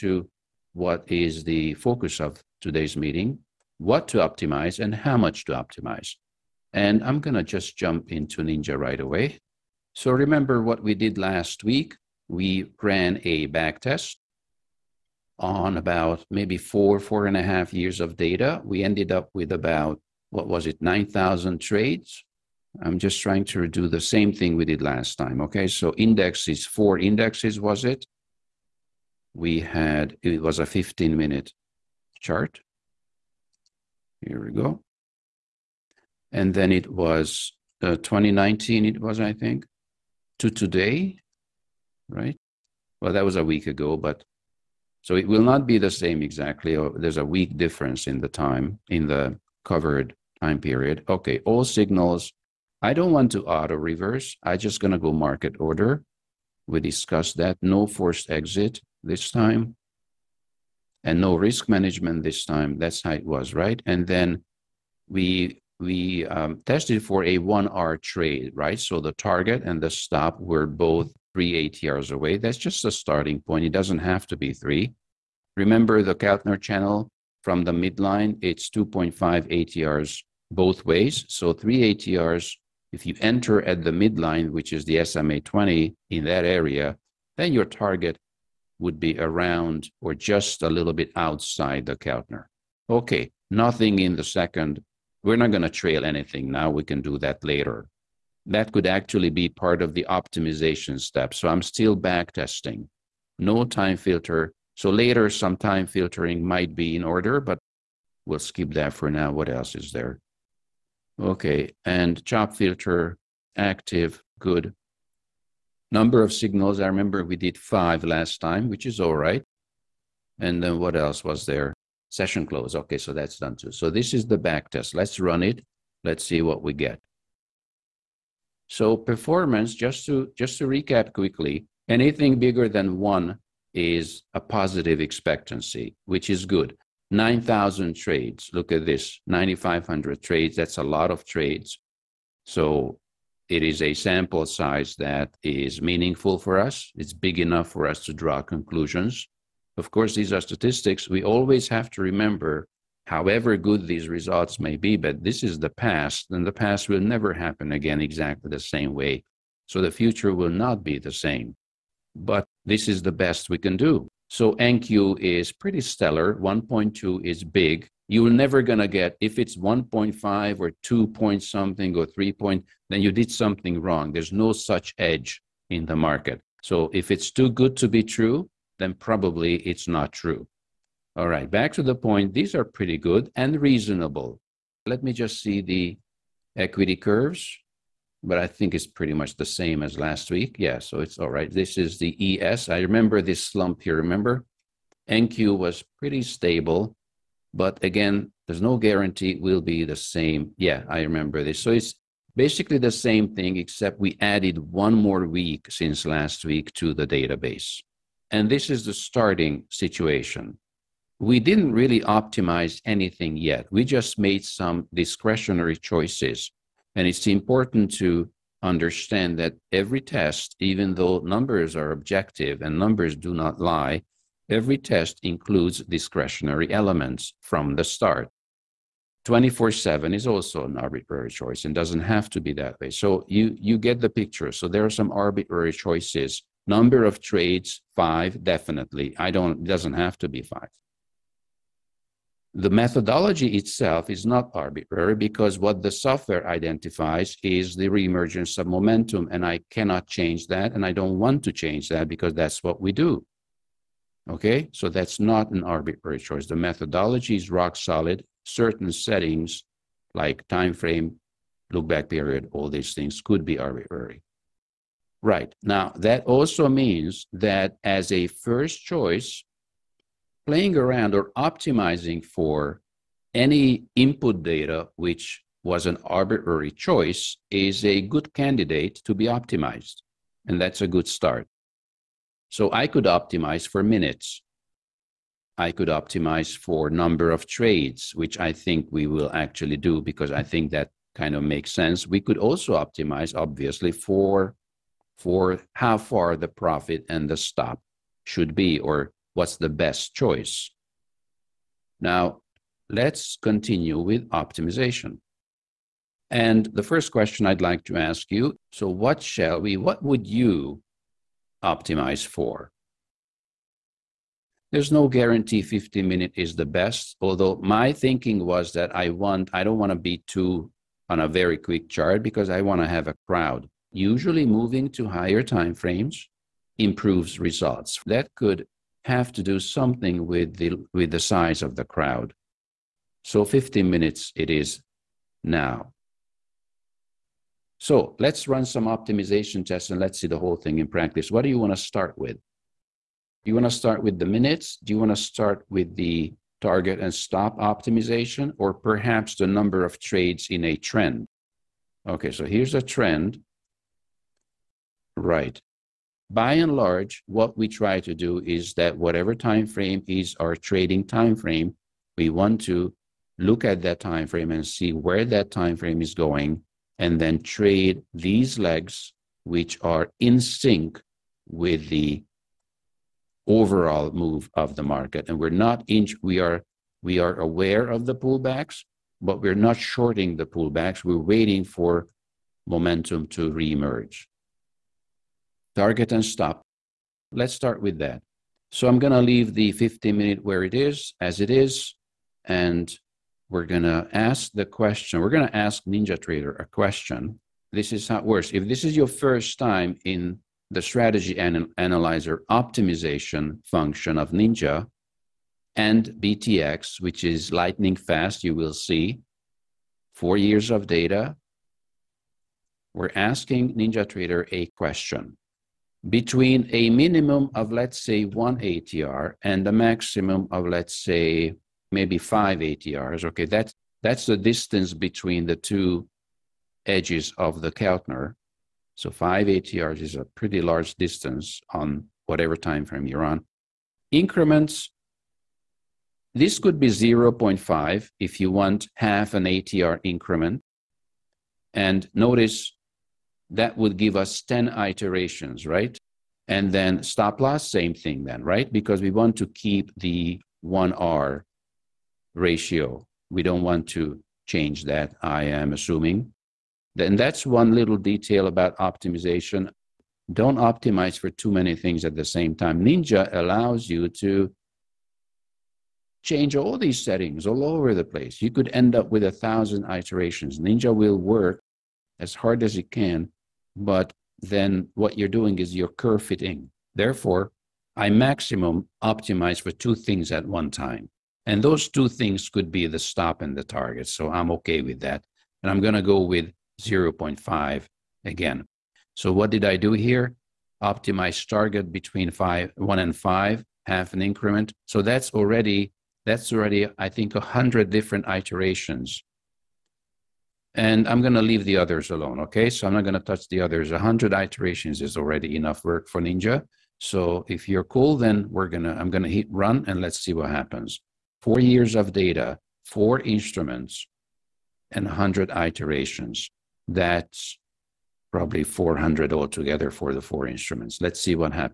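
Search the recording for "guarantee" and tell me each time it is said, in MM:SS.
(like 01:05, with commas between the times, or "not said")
03:18, 05:15.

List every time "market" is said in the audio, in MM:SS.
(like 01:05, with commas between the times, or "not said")
00:55, 02:55, 06:14.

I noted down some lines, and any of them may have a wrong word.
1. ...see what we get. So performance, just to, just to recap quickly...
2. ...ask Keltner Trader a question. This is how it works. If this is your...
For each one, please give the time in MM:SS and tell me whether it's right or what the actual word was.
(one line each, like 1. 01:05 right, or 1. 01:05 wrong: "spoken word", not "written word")
1. 02:06 right
2. 06:35 wrong: "Ninja", not "Keltner".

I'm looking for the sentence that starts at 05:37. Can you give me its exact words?
So let's run some optimization tests and let's see the whole thing in practice.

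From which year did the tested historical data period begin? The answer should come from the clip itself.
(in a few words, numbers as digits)
2019.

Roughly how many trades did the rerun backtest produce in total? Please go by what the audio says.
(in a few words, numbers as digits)
9,500.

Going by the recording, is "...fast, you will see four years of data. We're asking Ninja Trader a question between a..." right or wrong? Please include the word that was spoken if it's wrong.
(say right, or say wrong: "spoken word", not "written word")
right.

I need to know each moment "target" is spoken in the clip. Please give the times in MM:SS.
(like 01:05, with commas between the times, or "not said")
01:09, 01:27, 05:46, 06:25, 08:03, 08:11.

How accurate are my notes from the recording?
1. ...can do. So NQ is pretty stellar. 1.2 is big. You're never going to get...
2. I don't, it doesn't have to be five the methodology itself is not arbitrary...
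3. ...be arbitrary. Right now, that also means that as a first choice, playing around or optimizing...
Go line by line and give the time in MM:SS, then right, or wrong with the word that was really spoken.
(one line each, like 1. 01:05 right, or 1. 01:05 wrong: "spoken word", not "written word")
1. 02:43 right
2. 03:59 right
3. 04:23 right.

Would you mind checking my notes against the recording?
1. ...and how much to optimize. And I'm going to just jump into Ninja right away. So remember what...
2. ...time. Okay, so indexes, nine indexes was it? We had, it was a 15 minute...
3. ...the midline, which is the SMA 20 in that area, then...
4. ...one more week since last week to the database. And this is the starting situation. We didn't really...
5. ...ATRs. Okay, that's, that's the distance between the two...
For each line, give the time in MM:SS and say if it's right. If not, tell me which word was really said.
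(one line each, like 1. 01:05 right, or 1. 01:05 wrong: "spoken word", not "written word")
1. 00:04 right
2. 00:25 wrong: "four", not "nine"
3. 01:23 right
4. 03:24 right
5. 07:02 right.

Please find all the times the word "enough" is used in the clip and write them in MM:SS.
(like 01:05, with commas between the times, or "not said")
02:27, 08:25.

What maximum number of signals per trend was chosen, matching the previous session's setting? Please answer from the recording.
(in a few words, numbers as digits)
5.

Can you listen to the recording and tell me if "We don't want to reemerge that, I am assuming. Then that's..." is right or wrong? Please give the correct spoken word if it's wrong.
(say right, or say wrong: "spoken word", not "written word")
wrong: "change", not "reemerge".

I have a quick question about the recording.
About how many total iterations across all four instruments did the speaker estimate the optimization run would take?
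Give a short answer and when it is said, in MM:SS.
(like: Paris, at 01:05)
400, at 08:38.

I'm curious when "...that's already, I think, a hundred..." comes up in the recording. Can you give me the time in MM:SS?
08:16.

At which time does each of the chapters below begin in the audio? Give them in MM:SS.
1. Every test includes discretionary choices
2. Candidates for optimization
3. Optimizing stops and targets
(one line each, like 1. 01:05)
1. 03:41
2. 04:31
3. 06:51.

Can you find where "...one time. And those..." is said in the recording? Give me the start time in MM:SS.
08:00.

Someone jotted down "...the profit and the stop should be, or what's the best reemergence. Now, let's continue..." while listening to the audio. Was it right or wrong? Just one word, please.
wrong.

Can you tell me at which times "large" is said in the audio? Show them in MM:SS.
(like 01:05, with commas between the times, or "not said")
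05:56, 07:10.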